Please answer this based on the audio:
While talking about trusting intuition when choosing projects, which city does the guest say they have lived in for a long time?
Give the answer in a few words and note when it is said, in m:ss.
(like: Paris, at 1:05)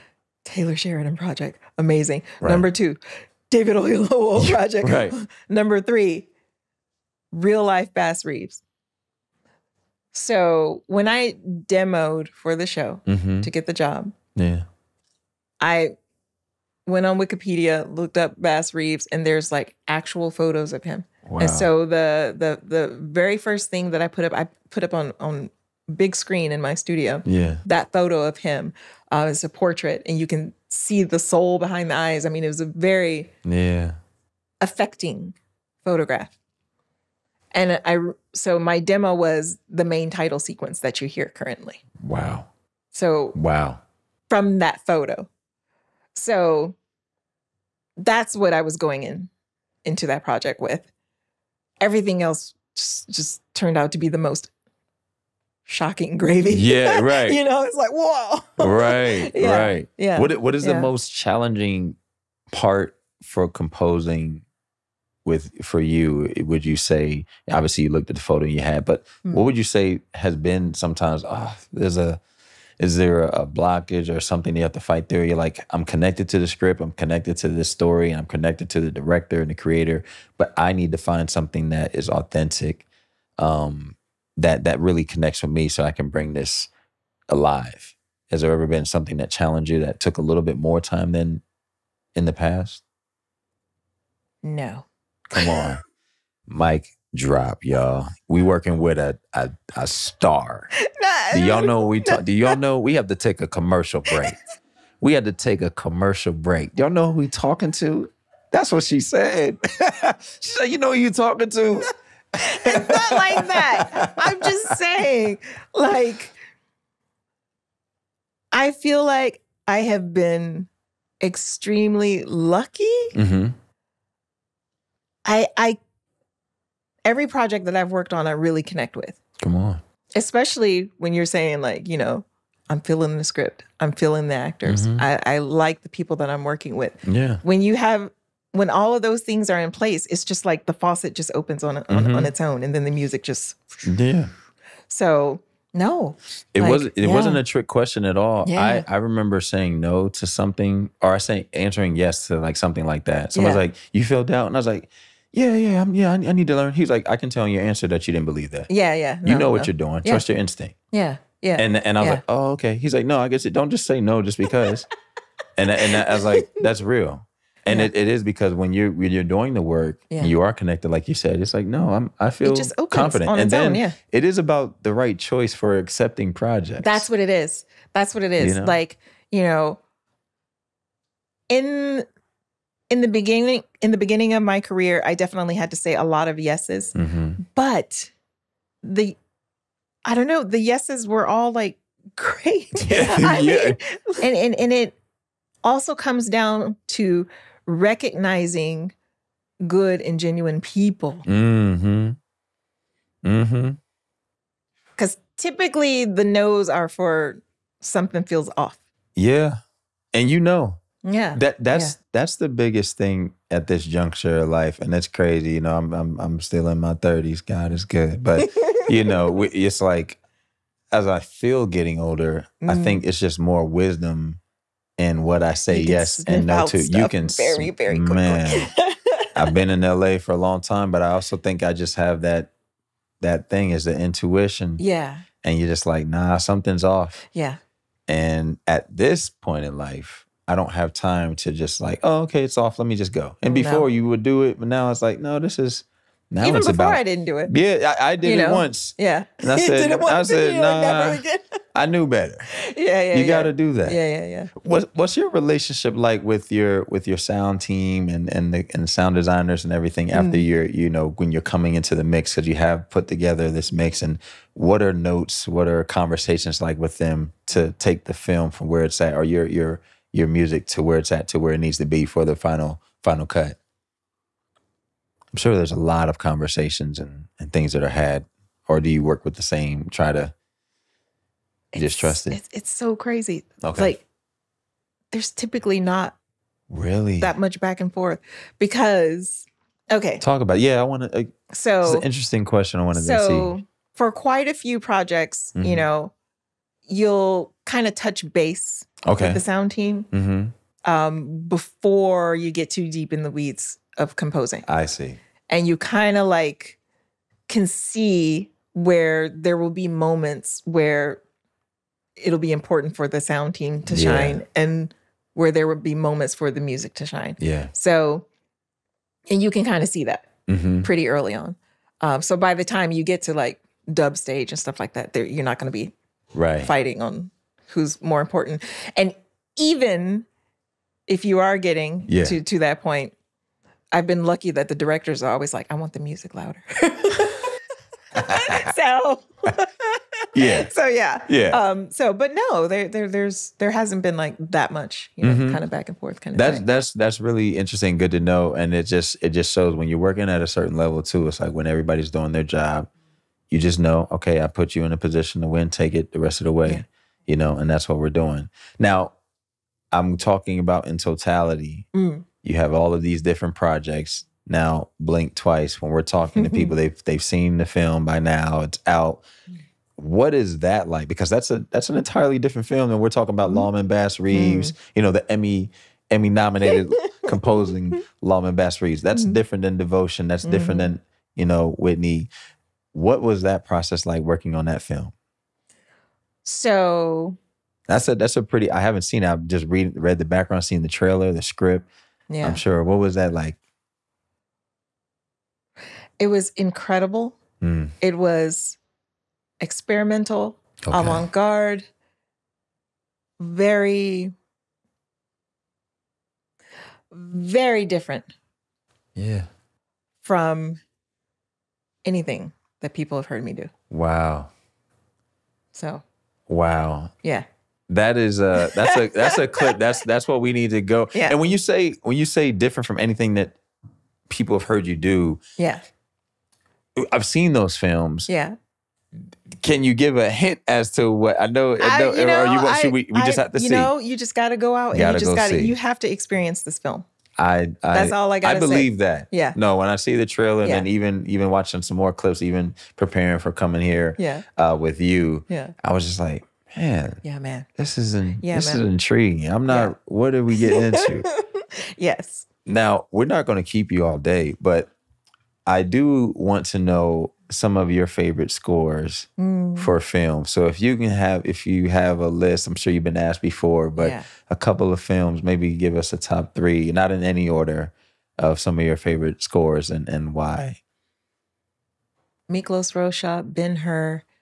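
LA, at 3:49.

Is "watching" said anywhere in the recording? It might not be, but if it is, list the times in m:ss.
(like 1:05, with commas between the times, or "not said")
7:21.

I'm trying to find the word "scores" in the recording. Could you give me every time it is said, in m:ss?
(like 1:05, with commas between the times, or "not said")
7:38, 7:49.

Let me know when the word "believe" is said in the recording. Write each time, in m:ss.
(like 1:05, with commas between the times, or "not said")
2:38, 7:18.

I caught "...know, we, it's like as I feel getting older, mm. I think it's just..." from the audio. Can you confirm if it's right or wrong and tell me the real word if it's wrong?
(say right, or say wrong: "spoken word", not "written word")
right.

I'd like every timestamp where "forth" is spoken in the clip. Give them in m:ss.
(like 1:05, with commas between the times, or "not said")
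4:47, 5:45.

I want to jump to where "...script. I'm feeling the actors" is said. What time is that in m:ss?
2:13.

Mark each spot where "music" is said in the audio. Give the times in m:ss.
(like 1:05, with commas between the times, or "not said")
2:22, 4:30, 5:16, 5:35.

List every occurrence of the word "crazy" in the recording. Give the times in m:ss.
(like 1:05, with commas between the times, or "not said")
3:35, 4:42.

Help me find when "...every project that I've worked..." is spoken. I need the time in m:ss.
2:07.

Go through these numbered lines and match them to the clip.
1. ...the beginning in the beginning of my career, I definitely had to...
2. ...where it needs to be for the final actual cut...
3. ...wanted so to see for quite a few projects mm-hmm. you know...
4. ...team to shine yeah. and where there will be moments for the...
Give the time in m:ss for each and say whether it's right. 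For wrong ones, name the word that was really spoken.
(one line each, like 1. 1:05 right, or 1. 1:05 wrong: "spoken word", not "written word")
1. 3:02 right
2. 4:31 wrong: "final", not "actual"
3. 4:52 right
4. 5:13 right.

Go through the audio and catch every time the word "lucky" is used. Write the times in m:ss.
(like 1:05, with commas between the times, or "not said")
2:02, 5:34.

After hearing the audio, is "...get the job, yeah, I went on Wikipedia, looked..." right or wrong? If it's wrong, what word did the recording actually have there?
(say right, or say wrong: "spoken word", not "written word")
right.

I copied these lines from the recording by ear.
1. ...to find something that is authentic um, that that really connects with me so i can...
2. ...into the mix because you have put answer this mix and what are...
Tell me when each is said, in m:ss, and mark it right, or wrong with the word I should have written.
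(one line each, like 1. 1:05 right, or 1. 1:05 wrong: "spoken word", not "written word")
1. 1:20 right
2. 4:21 wrong: "together", not "answer".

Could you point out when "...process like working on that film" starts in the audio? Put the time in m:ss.
6:23.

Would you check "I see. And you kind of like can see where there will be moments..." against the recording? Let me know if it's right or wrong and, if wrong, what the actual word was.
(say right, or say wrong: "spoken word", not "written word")
right.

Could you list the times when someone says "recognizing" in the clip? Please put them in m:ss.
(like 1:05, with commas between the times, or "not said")
3:17.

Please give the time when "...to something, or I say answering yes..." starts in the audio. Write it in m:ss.
2:30.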